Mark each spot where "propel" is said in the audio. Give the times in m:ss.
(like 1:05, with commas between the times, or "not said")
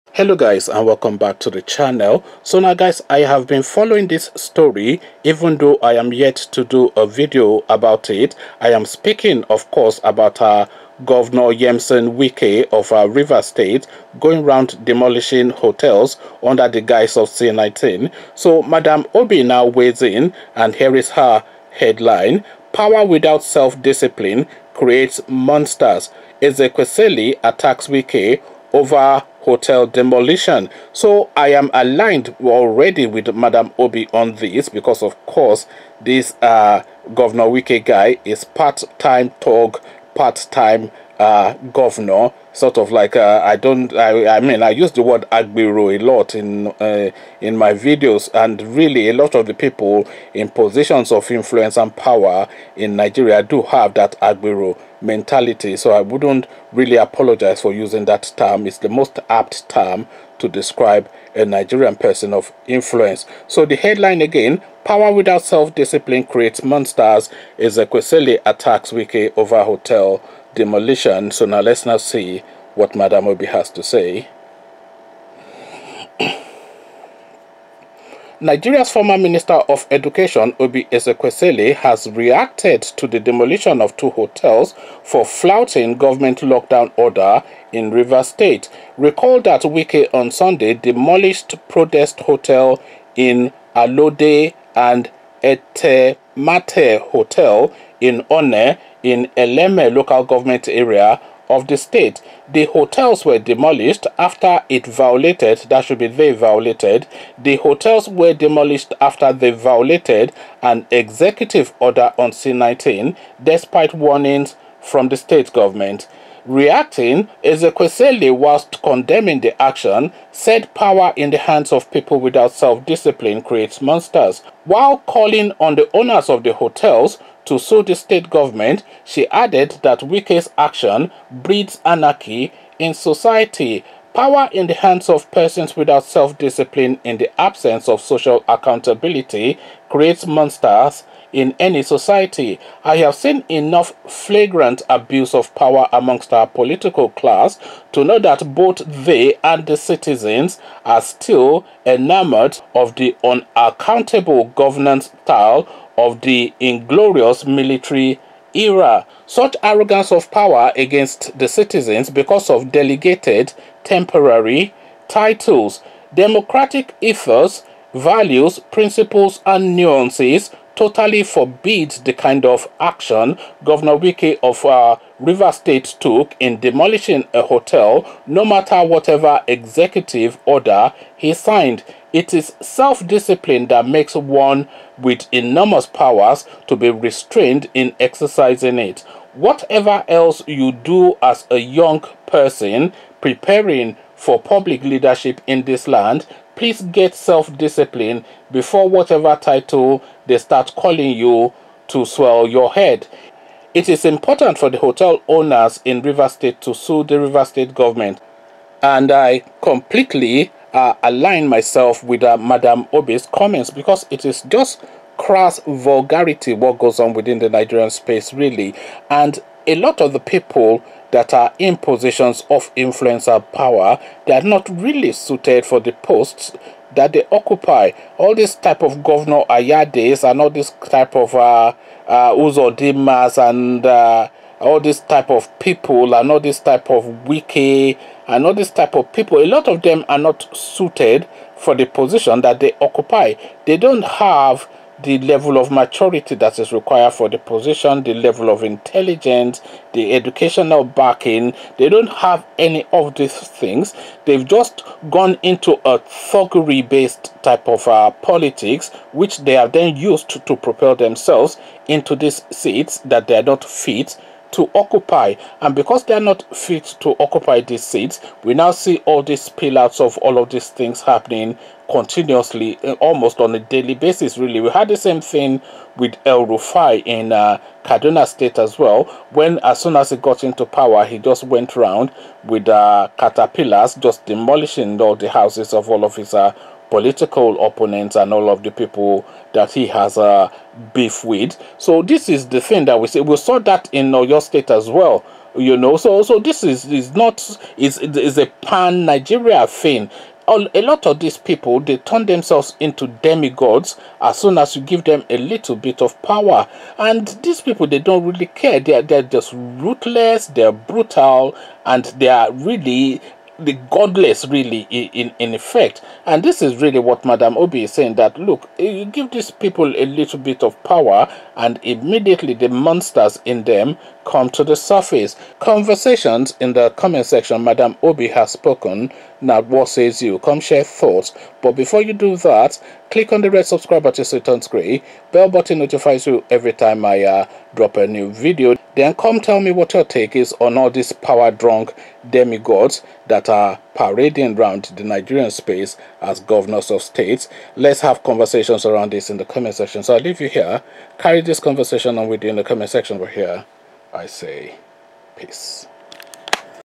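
4:20.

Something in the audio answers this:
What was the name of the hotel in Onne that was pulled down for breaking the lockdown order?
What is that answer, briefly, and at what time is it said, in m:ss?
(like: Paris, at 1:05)
Etemate Hotel, at 1:35.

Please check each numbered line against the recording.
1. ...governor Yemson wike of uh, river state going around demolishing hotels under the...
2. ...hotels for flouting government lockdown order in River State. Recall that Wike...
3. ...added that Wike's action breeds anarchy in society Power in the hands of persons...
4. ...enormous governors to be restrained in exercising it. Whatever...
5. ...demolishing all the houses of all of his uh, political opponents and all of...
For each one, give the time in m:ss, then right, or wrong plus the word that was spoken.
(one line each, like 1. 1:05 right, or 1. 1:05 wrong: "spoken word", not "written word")
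1. 0:11 right
2. 1:24 right
3. 2:09 right
4. 3:05 wrong: "powers", not "governors"
5. 4:44 right.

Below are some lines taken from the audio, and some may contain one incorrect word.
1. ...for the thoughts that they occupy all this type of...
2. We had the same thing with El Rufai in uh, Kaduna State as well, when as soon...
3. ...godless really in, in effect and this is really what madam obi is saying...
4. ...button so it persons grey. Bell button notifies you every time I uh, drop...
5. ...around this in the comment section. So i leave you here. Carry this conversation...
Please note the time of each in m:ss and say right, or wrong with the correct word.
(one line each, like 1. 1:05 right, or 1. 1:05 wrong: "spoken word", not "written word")
1. 3:45 wrong: "posts", not "thoughts"
2. 4:34 right
3. 5:13 right
4. 5:34 wrong: "turns", not "persons"
5. 5:48 right.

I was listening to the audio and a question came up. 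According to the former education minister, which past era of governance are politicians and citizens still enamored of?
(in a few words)
military era.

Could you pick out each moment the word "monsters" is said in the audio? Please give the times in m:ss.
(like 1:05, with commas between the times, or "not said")
0:25, 1:06, 2:03, 2:20, 5:22.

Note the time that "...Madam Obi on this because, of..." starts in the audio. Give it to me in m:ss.
0:33.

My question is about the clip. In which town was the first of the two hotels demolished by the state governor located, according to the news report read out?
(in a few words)
Alode.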